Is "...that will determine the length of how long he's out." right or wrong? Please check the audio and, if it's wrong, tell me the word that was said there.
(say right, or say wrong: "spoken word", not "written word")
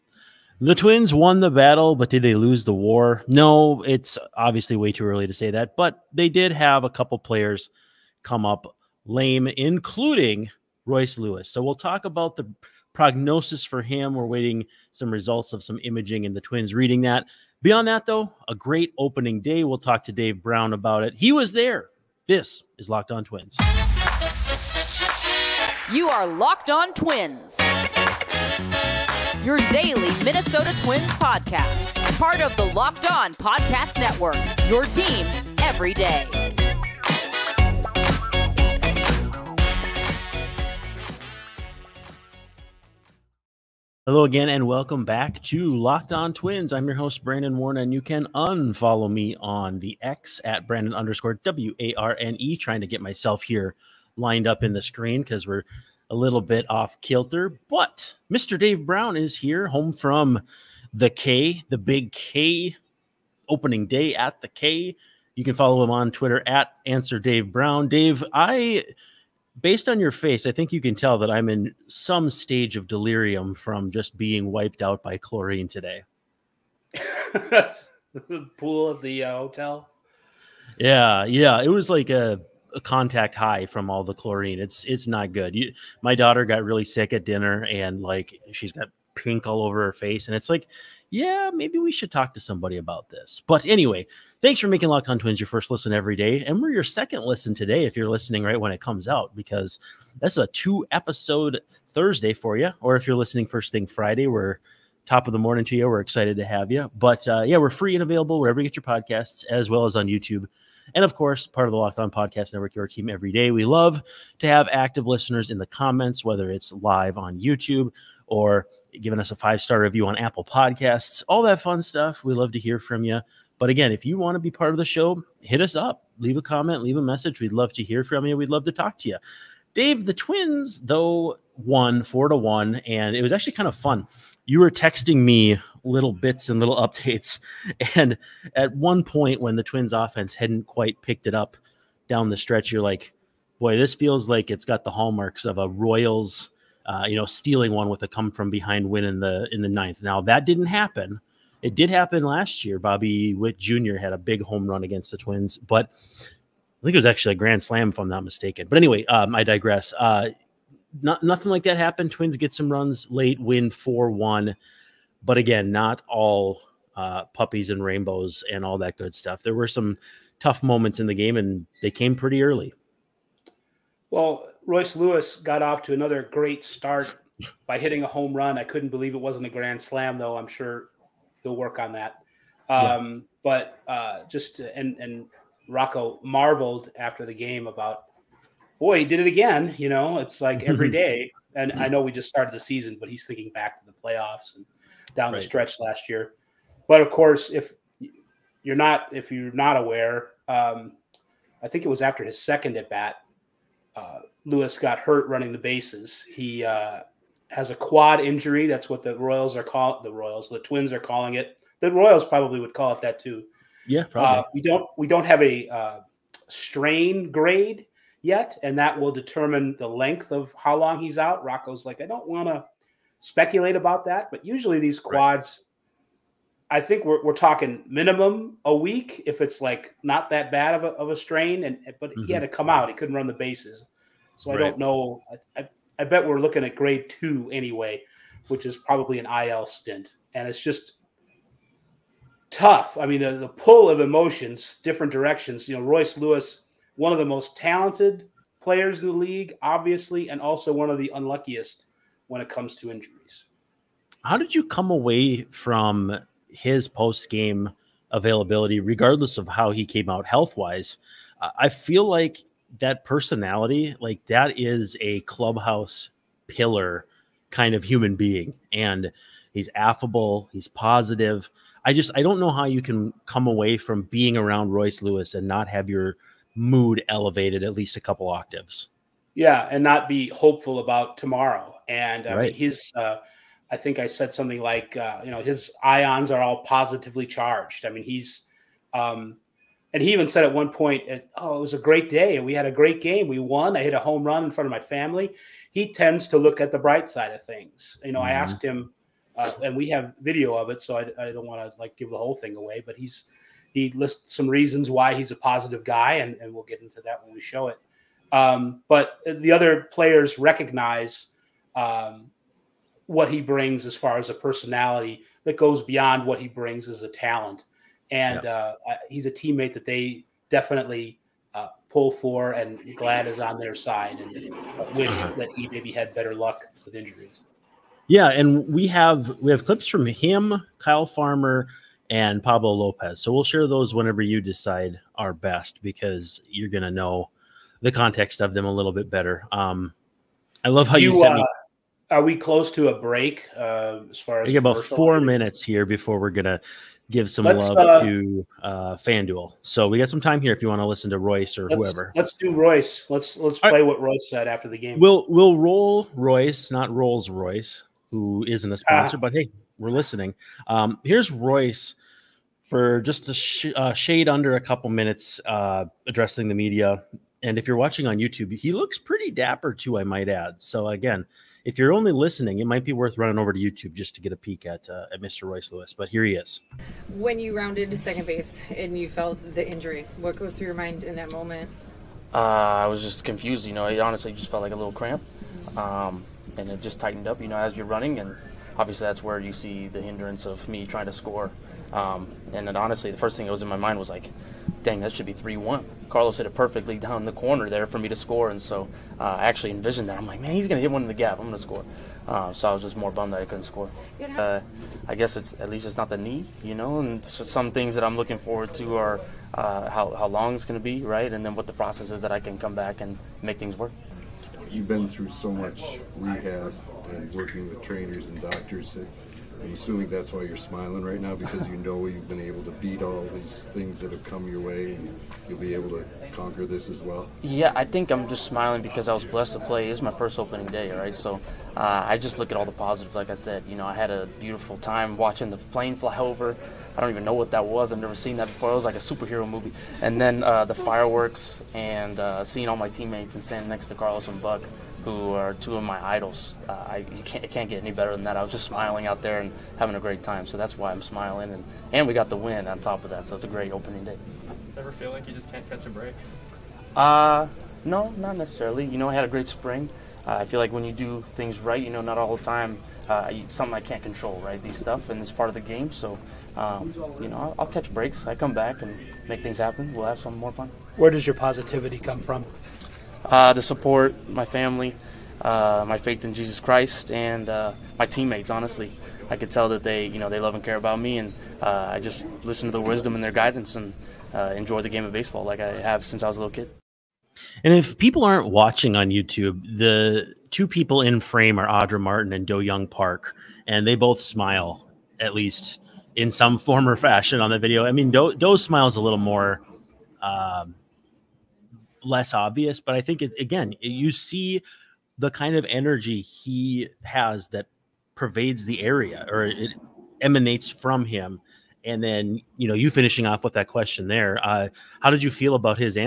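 right.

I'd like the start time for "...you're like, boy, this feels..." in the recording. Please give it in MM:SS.
02:22.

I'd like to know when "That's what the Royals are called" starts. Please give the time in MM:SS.
03:28.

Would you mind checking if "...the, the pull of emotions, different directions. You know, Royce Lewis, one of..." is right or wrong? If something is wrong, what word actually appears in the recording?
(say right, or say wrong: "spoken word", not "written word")
right.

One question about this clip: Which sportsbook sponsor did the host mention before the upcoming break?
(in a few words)
FanDuel.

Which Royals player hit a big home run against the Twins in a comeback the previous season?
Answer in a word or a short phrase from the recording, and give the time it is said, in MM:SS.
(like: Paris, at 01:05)
Bobby Witt Jr., at 02:32.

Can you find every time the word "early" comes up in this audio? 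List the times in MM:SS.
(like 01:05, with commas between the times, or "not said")
00:05, 02:52.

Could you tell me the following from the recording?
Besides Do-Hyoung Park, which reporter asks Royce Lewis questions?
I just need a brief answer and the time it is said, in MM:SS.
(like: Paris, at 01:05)
Audra Martin, at 08:11.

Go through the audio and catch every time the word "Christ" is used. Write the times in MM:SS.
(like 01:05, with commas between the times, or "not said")
07:56.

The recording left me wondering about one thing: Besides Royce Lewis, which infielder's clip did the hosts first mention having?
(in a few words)
Kyle Farmer.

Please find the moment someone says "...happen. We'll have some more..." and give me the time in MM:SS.
07:49.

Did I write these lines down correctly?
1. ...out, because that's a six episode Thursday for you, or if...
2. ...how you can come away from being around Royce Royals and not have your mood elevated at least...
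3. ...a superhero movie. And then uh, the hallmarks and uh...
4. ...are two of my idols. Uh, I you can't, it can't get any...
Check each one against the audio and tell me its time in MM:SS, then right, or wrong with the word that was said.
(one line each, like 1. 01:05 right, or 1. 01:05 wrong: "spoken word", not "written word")
1. 01:39 wrong: "two", not "six"
2. 04:32 wrong: "Lewis", not "Royals"
3. 07:18 wrong: "fireworks", not "hallmarks"
4. 07:25 right.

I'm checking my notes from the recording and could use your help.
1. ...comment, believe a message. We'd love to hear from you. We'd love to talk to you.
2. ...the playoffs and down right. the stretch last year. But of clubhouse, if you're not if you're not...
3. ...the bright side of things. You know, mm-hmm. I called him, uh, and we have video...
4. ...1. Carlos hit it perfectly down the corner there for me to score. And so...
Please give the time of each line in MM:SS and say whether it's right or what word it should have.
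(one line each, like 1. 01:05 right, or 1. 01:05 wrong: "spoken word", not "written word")
1. 02:06 wrong: "leave", not "believe"
2. 03:13 wrong: "course", not "clubhouse"
3. 04:56 wrong: "asked", not "called"
4. 06:35 right.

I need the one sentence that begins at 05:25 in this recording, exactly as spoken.
that he maybe had better luck with injuries.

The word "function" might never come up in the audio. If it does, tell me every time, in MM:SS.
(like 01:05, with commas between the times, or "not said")
not said.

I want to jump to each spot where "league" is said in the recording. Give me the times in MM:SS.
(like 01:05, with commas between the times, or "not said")
04:09.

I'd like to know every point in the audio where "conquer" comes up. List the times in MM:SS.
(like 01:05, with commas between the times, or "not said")
07:06.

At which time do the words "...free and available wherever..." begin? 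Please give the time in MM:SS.
01:47.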